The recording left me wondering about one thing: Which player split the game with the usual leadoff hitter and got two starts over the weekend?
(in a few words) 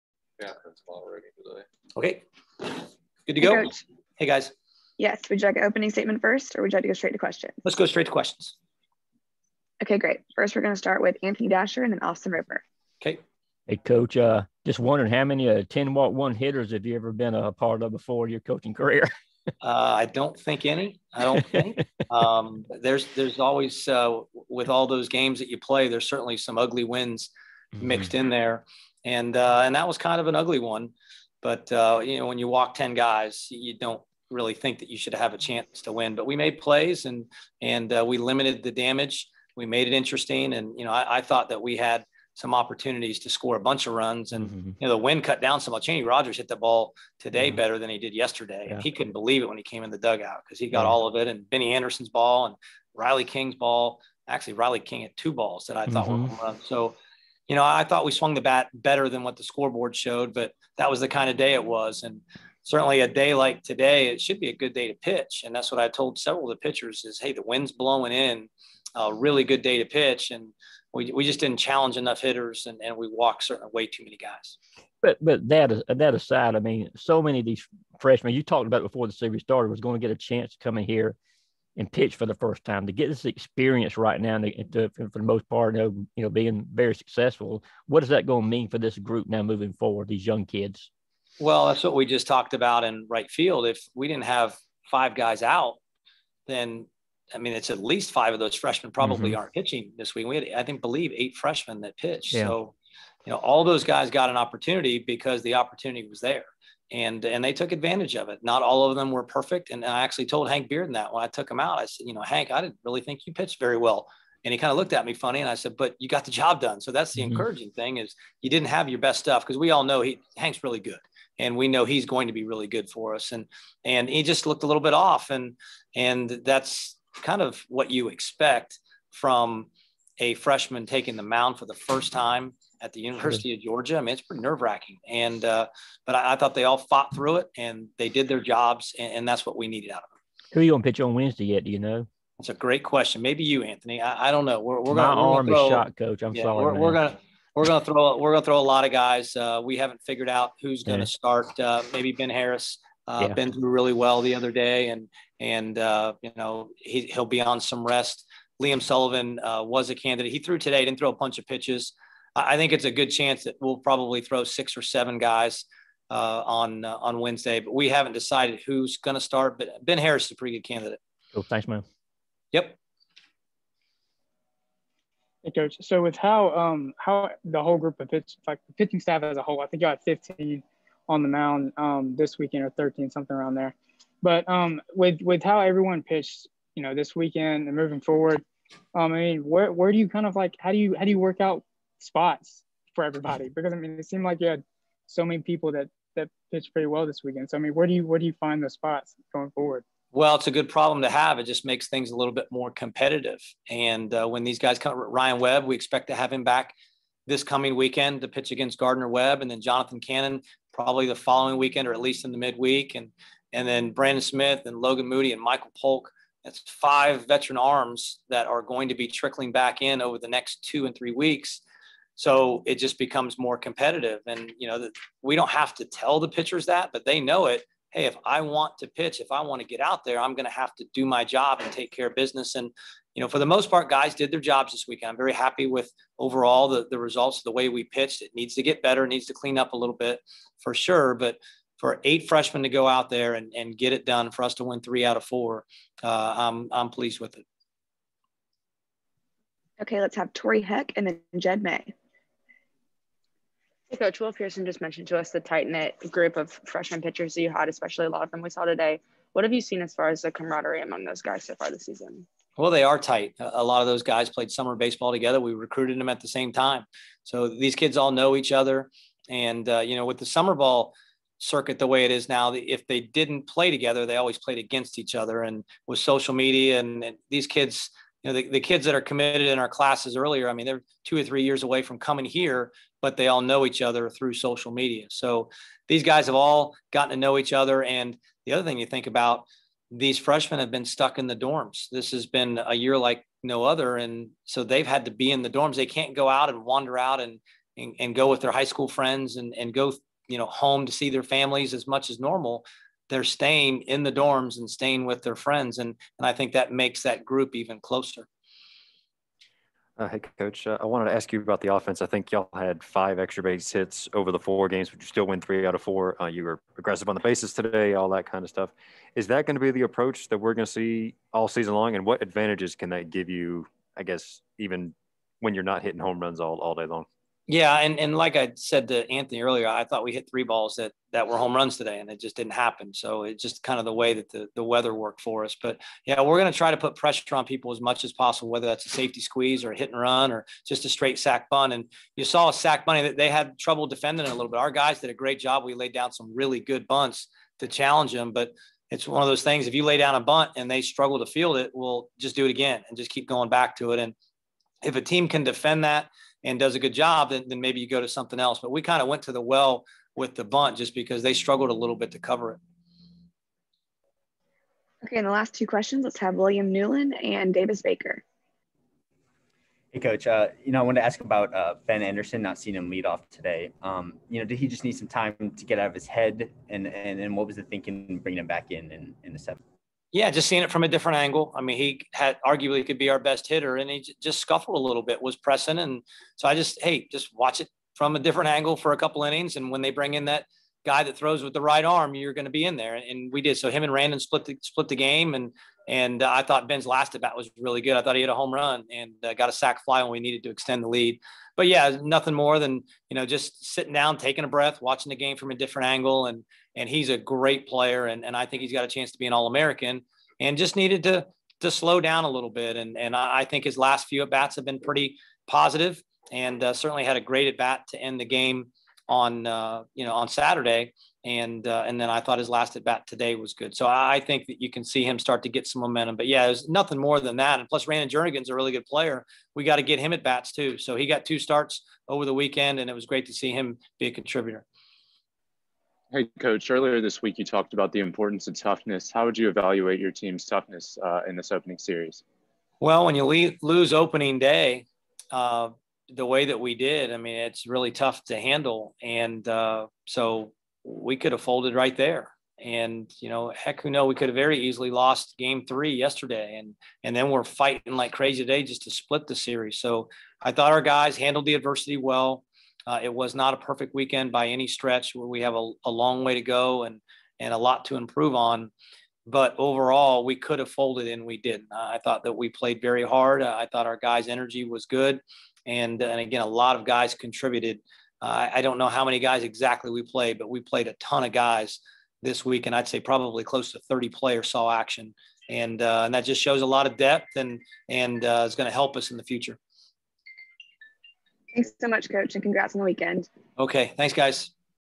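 Randon Jernigan.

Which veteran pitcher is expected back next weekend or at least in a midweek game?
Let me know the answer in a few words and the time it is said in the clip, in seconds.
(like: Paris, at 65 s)
Jonathan Cannon, at 209 s.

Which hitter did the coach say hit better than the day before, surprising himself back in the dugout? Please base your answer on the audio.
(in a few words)
Chaney Rogers.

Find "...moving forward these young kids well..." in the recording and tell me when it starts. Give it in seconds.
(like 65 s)
89 s.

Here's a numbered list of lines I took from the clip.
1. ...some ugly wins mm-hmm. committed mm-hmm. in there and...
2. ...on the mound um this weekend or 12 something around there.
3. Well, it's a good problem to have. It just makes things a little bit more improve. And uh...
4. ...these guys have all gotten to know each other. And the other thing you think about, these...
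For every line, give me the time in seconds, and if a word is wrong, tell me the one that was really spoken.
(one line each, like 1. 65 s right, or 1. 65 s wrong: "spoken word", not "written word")
1. 26 s wrong: "mixed", not "committed"
2. 181 s wrong: "13", not "12"
3. 200 s wrong: "competitive", not "improve"
4. 285 s right.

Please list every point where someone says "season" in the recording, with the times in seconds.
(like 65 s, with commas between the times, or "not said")
261 s, 321 s.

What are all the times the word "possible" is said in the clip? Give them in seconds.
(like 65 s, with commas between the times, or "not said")
338 s.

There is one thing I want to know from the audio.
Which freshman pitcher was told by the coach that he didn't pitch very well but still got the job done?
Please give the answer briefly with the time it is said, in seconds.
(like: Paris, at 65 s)
Hank Bearden, at 110 s.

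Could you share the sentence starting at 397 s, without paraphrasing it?
I thought he hit a home run and uh, got a sac fly when we needed to extend the lead.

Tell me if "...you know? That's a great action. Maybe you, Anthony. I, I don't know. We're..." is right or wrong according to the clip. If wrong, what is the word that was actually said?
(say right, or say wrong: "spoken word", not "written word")
wrong: "question", not "action".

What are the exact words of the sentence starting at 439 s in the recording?
How would you evaluate your team's toughness uh, in this opening series?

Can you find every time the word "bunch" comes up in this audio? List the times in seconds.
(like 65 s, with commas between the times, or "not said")
43 s, 161 s.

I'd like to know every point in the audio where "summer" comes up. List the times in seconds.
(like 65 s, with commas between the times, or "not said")
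264 s, 270 s.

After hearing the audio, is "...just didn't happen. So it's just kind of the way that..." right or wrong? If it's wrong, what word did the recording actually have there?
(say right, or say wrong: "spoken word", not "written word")
right.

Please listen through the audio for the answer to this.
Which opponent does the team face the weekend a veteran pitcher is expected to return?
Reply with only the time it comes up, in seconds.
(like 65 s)
208 s.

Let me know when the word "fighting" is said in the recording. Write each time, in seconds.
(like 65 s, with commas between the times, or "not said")
457 s.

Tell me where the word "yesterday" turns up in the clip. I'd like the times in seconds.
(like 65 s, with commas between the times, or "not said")
48 s, 455 s.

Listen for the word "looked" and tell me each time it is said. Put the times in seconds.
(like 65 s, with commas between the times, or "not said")
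114 s, 124 s.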